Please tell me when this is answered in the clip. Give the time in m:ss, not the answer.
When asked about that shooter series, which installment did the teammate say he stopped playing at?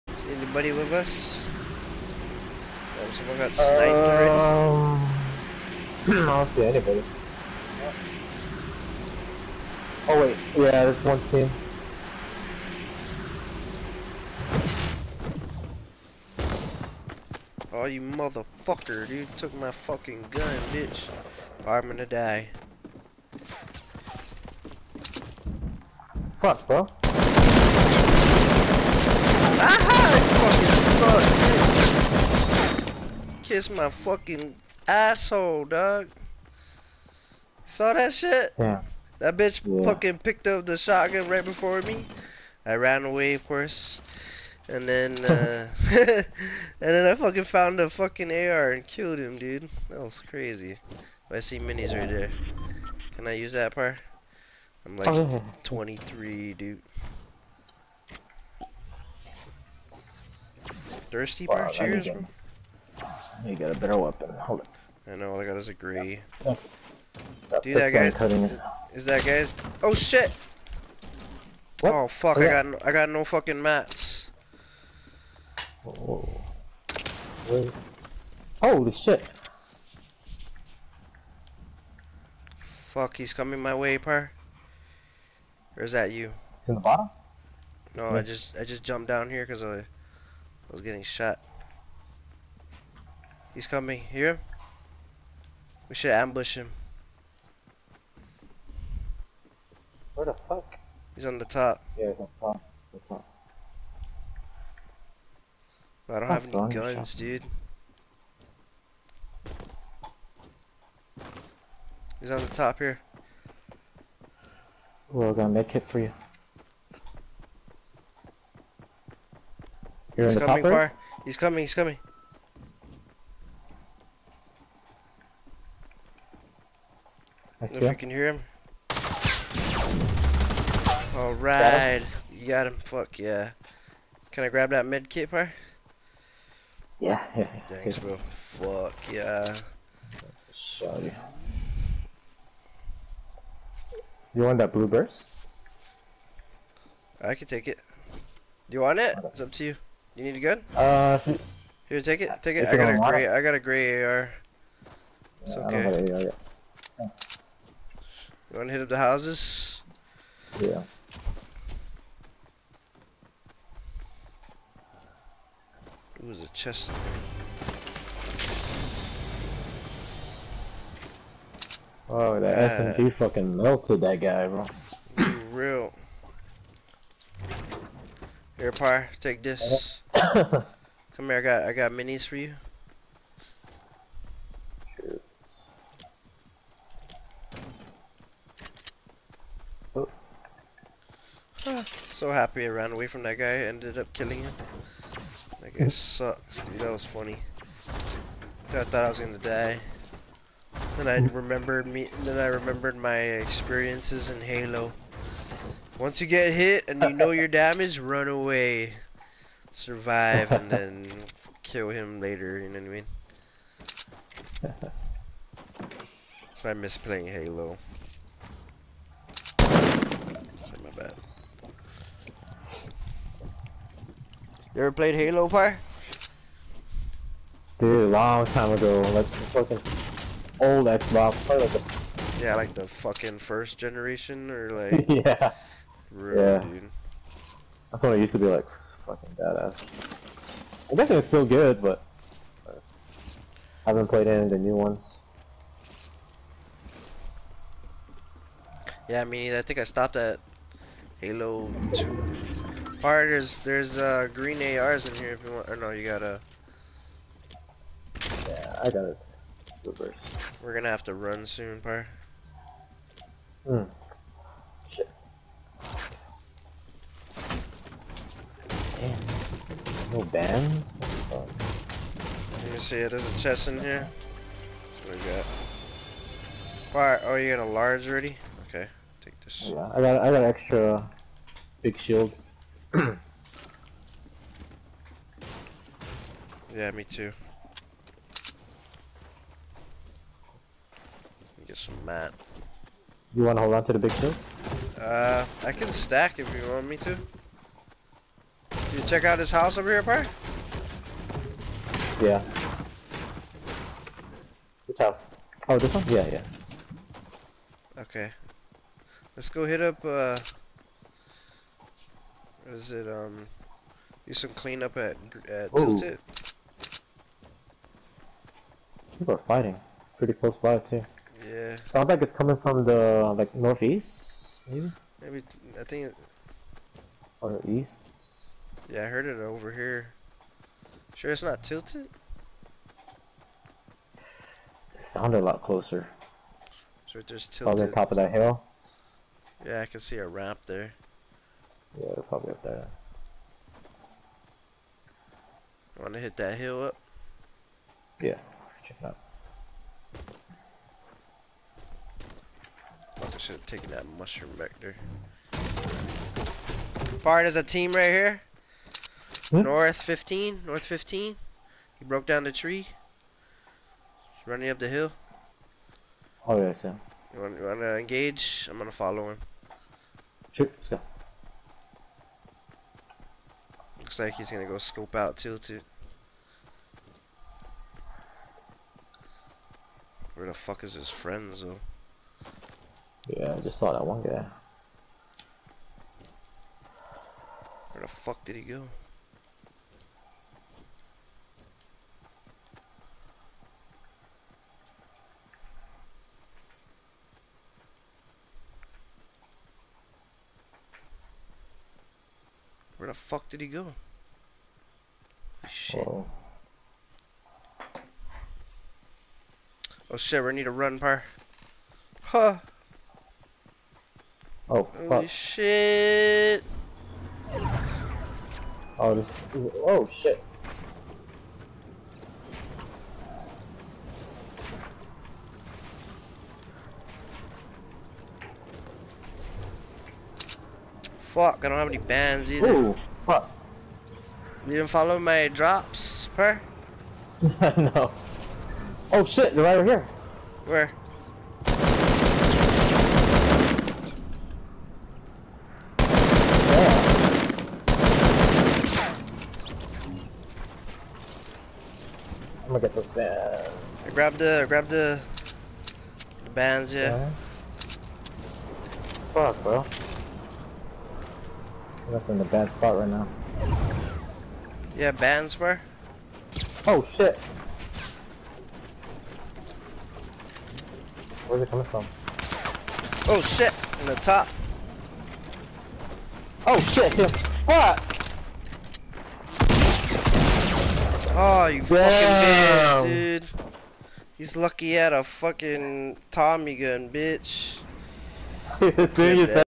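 4:09.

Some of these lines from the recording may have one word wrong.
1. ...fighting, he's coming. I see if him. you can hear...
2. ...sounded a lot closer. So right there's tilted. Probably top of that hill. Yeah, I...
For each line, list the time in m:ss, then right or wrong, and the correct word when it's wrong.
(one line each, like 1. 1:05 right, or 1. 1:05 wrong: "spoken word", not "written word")
1. 2:01 wrong: "coming", not "fighting"
2. 5:35 right.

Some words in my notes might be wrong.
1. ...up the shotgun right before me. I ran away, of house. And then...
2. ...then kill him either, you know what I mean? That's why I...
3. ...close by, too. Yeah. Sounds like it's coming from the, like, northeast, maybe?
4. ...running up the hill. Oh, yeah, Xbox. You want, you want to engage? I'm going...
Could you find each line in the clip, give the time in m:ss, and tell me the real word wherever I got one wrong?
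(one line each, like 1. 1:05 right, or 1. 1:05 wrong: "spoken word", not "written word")
1. 0:40 wrong: "course", not "house"
2. 3:30 wrong: "later", not "either"
3. 5:20 right
4. 6:04 wrong: "Sam", not "Xbox".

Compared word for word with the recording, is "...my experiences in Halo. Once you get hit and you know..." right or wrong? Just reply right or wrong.
right.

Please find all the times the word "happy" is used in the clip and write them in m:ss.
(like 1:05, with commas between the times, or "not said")
3:12.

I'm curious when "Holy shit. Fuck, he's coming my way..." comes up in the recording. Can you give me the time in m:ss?
1:18.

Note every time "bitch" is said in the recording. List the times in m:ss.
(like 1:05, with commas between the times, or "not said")
0:20, 0:39, 8:03, 8:07.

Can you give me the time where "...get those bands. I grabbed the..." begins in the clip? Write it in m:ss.
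7:32.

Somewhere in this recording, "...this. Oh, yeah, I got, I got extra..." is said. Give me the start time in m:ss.
4:39.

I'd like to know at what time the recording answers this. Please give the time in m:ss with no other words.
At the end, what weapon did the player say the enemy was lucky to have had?
8:05.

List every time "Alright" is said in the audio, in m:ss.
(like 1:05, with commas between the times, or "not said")
2:11, 4:13.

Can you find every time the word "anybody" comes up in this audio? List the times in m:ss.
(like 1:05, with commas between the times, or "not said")
0:00, 0:06.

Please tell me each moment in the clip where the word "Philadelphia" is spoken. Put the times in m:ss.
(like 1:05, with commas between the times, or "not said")
not said.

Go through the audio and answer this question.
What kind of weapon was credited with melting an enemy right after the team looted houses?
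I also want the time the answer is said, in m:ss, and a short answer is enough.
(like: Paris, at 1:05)
SMG, at 2:52.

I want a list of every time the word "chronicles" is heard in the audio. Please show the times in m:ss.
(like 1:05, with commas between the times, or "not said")
not said.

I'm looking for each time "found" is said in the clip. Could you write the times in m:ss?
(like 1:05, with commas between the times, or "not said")
0:47.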